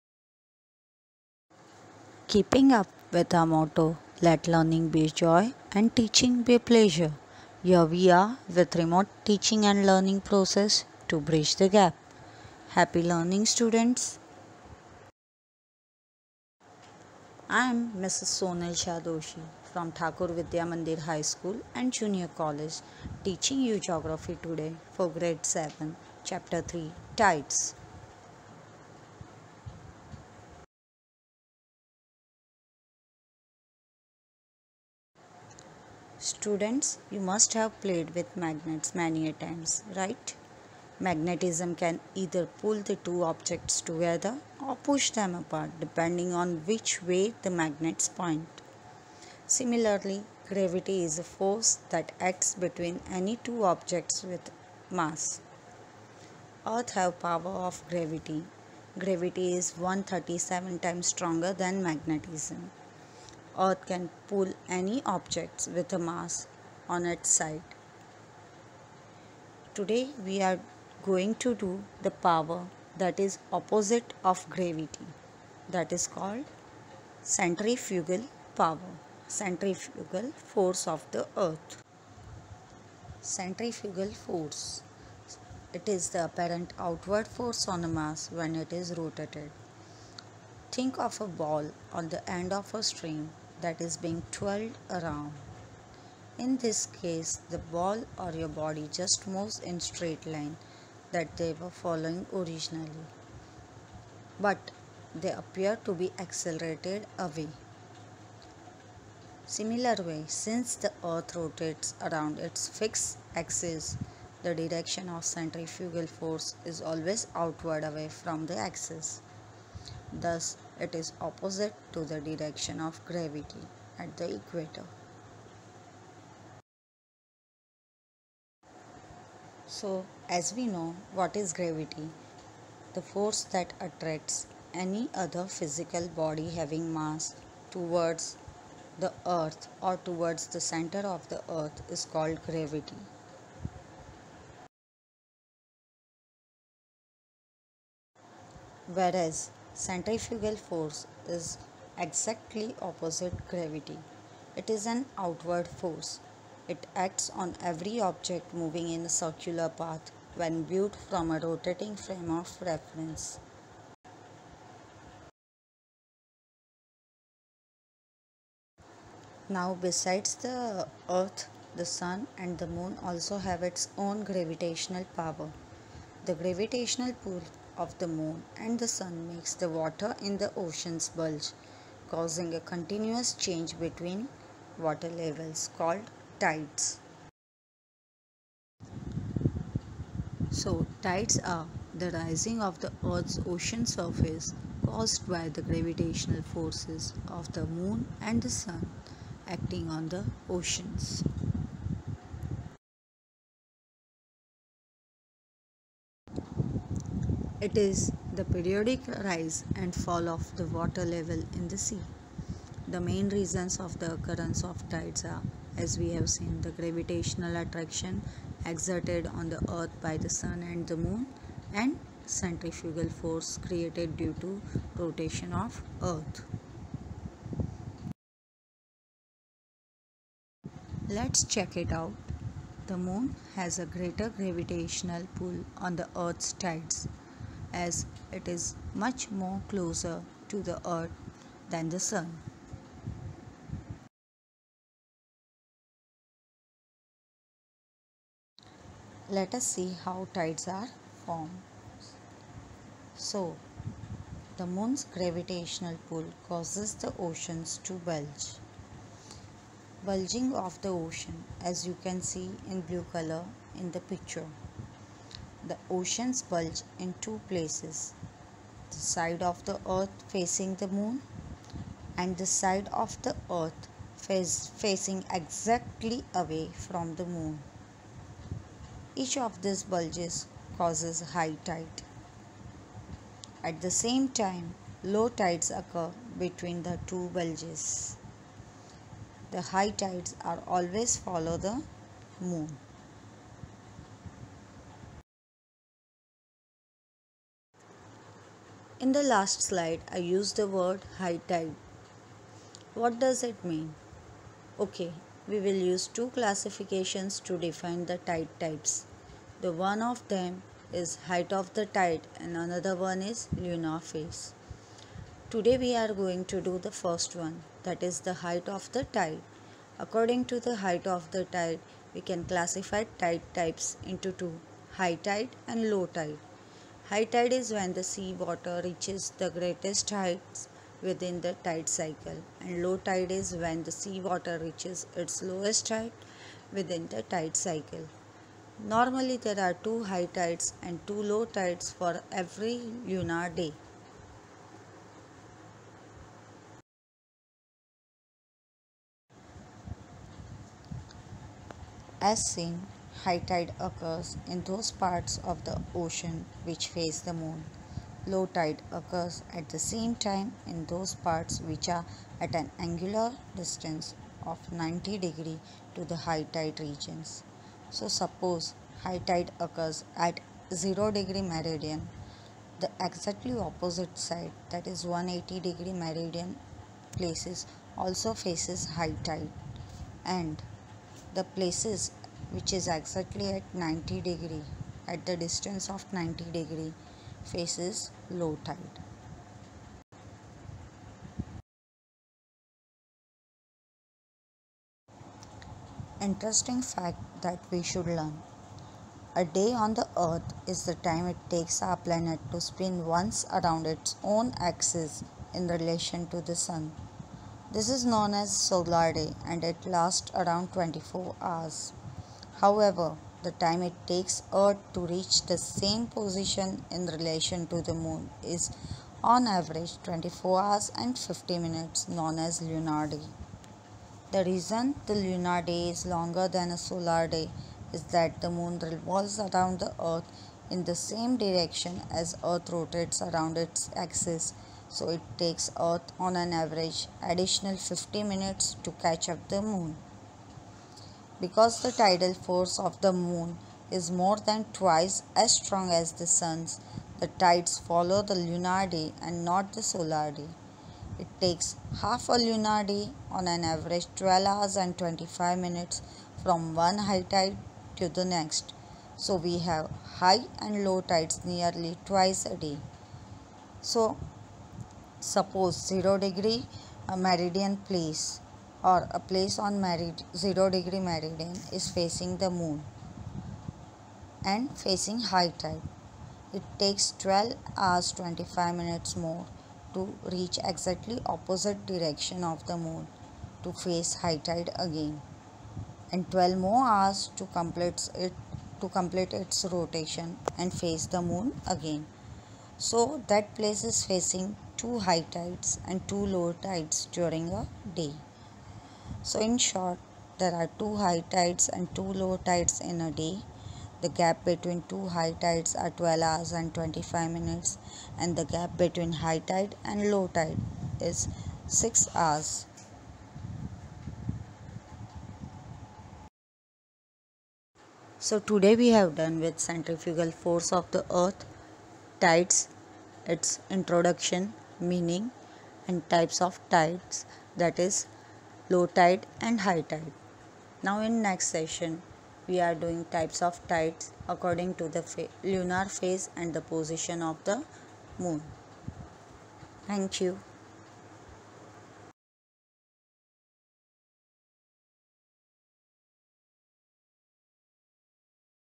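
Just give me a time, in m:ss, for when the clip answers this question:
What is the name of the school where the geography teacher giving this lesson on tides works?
0:19.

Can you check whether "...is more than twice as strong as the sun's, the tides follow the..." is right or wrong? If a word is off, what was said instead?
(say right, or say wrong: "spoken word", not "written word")
right.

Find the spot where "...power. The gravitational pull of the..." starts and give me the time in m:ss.
2:55.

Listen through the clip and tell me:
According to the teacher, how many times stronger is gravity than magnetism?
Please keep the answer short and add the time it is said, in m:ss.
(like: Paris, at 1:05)
137, at 0:59.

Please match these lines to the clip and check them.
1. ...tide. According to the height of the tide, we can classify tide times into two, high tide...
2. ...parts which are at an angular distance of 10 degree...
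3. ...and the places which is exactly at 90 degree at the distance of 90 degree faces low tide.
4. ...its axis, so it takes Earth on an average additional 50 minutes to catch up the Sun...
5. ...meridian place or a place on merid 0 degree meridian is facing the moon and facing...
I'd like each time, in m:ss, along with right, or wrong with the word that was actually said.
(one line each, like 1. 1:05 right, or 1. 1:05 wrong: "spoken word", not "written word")
1. 5:19 wrong: "types", not "times"
2. 6:01 wrong: "90", not "10"
3. 6:20 right
4. 7:13 wrong: "Moon", not "Sun"
5. 7:47 right.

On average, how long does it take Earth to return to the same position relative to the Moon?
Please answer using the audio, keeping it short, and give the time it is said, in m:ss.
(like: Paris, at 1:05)
24 hours and 50 minutes, at 7:00.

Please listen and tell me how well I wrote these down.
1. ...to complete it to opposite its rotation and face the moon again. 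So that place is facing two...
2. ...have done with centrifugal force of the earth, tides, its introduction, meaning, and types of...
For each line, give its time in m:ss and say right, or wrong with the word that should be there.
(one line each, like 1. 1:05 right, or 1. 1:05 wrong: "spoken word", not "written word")
1. 8:07 wrong: "complete", not "opposite"
2. 8:38 right.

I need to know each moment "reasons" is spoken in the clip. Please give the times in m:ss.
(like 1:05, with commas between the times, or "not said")
3:33, 7:04.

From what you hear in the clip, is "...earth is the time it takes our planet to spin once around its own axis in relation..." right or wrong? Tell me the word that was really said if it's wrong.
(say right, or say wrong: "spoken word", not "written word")
right.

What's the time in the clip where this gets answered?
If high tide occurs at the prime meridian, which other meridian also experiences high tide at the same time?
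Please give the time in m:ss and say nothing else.
6:15.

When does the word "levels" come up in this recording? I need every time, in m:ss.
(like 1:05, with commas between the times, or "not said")
3:05, 3:31.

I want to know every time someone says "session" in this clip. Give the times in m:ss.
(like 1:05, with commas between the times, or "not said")
8:51.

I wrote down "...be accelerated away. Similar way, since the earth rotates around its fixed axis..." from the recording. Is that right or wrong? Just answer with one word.
right.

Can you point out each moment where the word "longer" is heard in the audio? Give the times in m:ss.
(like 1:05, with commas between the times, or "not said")
7:06.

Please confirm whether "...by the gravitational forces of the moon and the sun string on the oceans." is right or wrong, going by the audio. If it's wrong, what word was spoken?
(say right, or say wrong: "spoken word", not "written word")
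wrong: "acting", not "string".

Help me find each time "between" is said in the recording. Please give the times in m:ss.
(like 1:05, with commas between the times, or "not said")
0:52, 3:03, 4:46, 8:24, 8:28.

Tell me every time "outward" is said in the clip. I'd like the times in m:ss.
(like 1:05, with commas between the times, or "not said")
1:26, 1:57, 2:35.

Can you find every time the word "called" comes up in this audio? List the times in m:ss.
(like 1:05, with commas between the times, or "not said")
1:16, 2:22, 3:05.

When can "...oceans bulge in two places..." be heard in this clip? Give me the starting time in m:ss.
4:25.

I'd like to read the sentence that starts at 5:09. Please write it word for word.
The one of them is height of the tide and another one is lunar phase.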